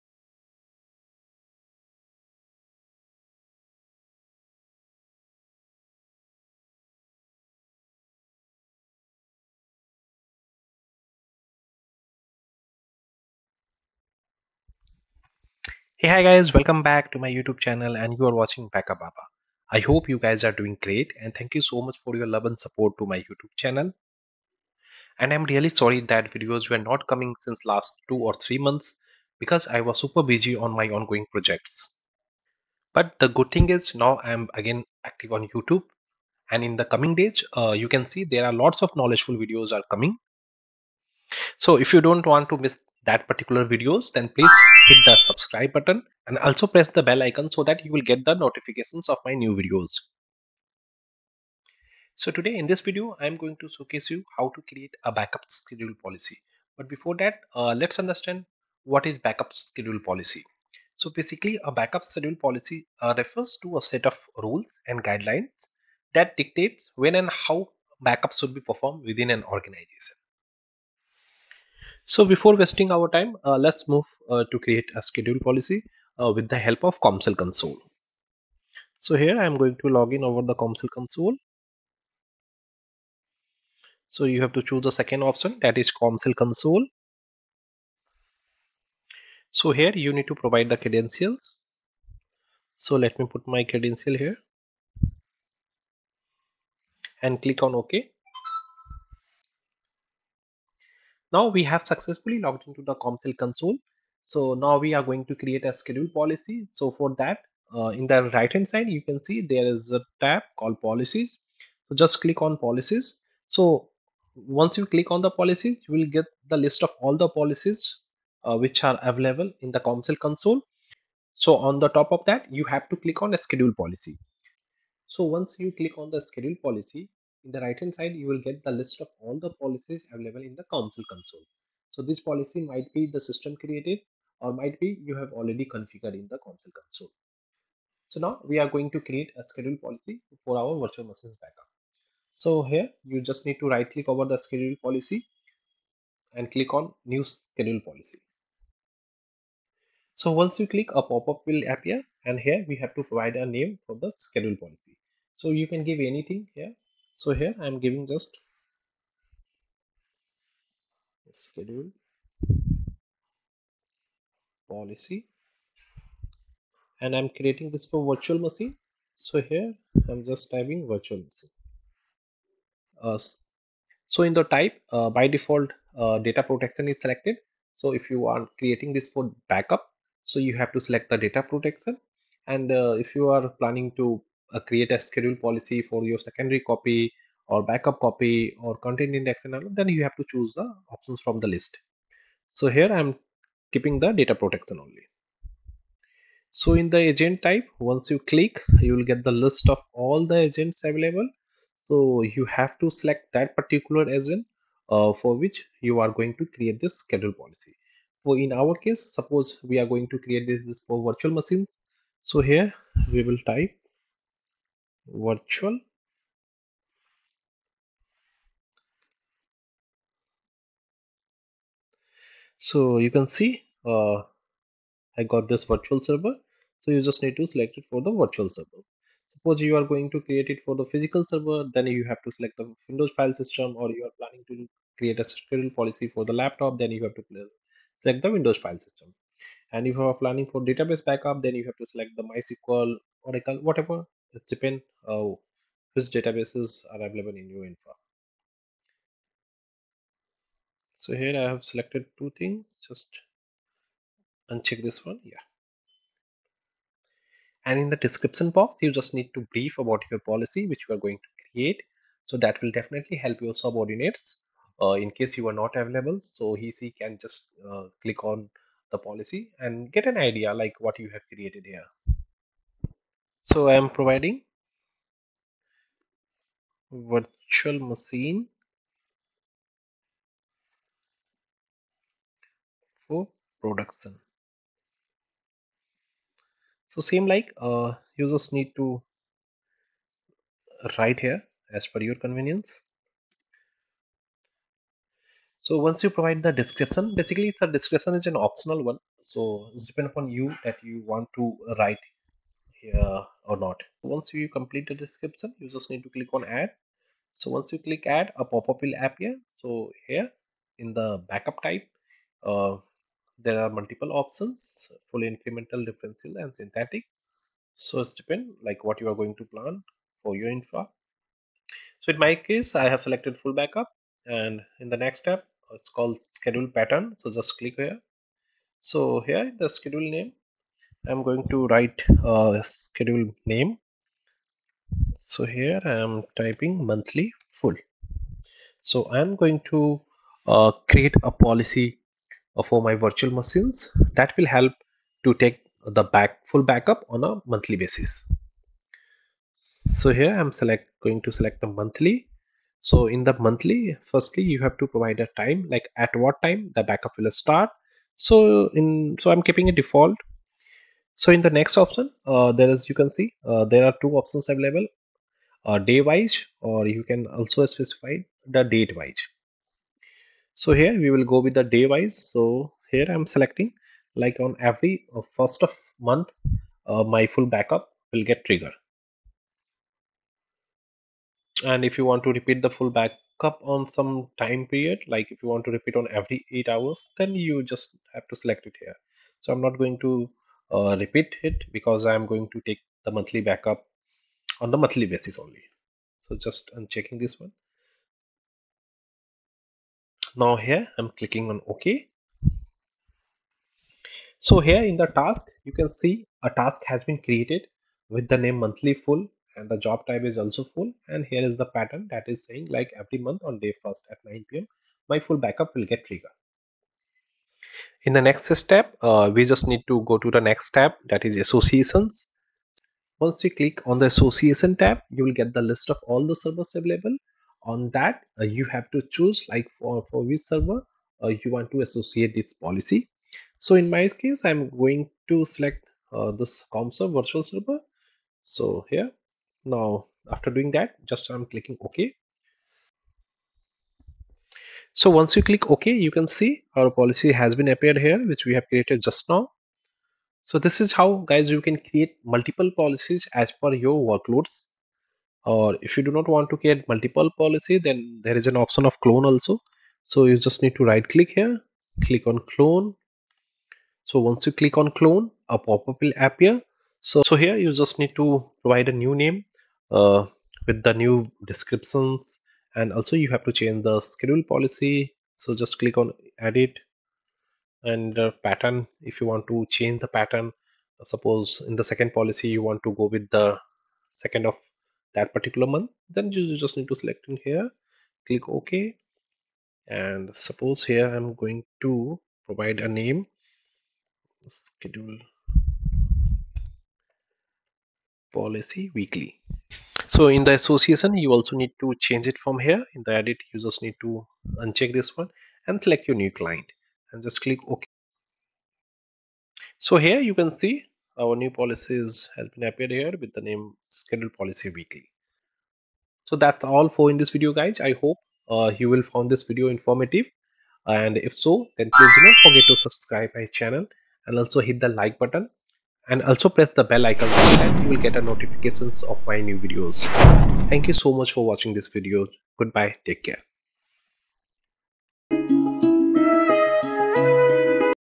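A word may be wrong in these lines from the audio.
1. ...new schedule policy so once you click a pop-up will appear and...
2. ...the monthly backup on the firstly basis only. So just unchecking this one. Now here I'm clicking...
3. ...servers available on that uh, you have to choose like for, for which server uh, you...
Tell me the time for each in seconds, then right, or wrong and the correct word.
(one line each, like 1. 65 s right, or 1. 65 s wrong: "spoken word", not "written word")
1. 147 s right
2. 393 s wrong: "monthly", not "firstly"
3. 426 s right.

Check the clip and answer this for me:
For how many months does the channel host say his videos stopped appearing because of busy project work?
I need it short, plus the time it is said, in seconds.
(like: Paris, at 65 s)
2 or 3, at 28 s.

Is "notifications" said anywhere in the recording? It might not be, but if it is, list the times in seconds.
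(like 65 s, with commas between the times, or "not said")
48 s, 528 s.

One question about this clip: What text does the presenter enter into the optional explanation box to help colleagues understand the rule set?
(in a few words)
virtual machine for production.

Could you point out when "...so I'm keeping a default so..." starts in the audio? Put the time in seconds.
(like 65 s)
359 s.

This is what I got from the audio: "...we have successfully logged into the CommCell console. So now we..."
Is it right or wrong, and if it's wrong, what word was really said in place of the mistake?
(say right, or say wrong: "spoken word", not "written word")
right.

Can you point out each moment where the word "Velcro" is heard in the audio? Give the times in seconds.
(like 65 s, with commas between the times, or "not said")
not said.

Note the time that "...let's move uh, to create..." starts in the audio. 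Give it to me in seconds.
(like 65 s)
73 s.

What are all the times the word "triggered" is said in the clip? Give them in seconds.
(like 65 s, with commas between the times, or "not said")
378 s, 416 s.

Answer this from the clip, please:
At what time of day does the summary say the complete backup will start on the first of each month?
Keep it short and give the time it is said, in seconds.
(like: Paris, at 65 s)
9 p.m., at 414 s.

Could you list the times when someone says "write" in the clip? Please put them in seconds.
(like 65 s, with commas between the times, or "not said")
290 s, 301 s, 331 s.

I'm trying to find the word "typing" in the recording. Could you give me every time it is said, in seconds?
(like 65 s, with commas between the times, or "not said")
170 s, 336 s.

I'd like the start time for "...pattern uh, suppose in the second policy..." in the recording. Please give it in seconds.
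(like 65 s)
480 s.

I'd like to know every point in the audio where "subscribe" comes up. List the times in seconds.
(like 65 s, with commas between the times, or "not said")
45 s, 522 s.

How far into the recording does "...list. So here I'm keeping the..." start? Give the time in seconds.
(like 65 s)
191 s.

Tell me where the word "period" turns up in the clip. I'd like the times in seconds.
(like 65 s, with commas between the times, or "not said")
384 s.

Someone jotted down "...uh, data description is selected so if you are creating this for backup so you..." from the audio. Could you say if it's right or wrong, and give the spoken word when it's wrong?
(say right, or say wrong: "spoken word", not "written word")
wrong: "protection", not "description".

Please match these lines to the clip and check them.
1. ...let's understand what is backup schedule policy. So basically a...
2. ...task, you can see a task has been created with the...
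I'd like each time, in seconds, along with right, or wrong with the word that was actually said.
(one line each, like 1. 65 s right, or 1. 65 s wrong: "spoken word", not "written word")
1. 57 s right
2. 405 s right.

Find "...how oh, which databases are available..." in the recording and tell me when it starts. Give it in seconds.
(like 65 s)
245 s.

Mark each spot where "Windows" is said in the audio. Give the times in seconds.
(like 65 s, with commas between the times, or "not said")
232 s, 238 s.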